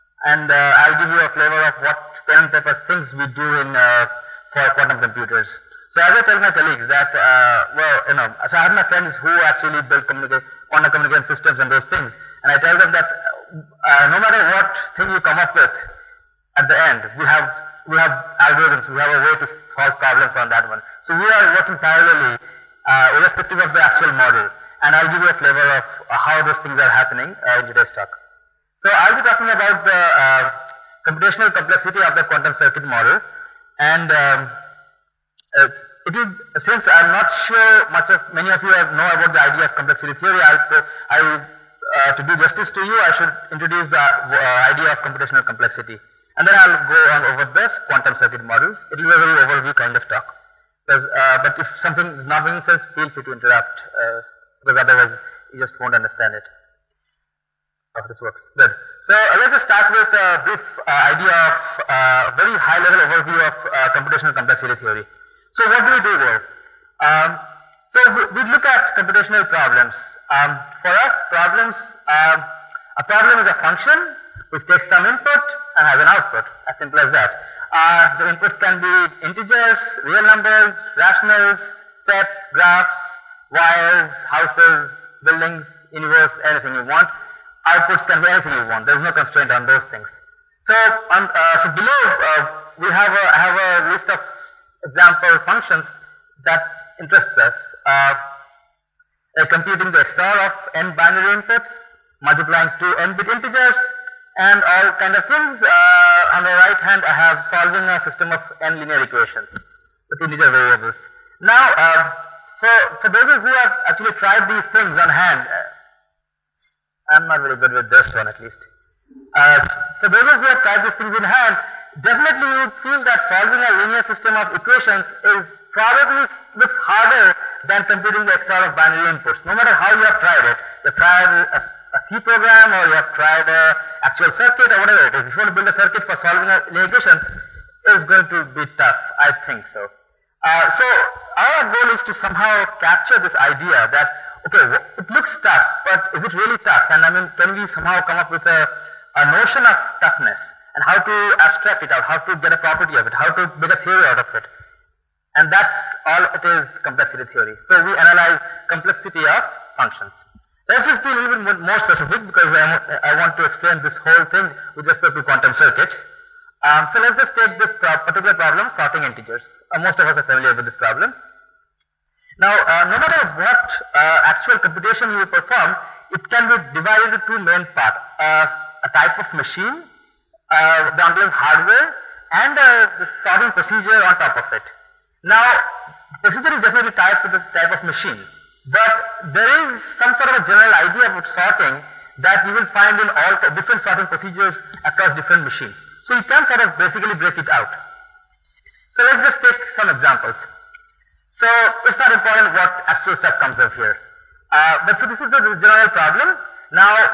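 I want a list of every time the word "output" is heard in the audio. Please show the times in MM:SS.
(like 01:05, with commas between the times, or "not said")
01:16, 01:27.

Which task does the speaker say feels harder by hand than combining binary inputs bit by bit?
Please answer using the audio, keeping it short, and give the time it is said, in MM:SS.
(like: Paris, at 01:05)
solving a linear system of equations, at 02:03.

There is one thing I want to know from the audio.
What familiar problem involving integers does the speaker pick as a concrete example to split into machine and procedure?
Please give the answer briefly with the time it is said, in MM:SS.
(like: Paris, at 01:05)
sorting integers, at 02:48.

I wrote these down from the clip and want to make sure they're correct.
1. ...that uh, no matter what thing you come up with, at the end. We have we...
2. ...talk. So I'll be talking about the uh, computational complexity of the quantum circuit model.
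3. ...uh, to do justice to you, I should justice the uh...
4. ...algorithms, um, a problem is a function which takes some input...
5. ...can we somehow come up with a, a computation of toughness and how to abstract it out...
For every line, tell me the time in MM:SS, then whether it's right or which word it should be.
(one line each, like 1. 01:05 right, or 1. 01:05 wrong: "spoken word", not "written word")
1. 00:12 right
2. 00:27 right
3. 00:41 wrong: "introduce", not "justice"
4. 01:11 wrong: "problems", not "algorithms"
5. 02:27 wrong: "notion", not "computation".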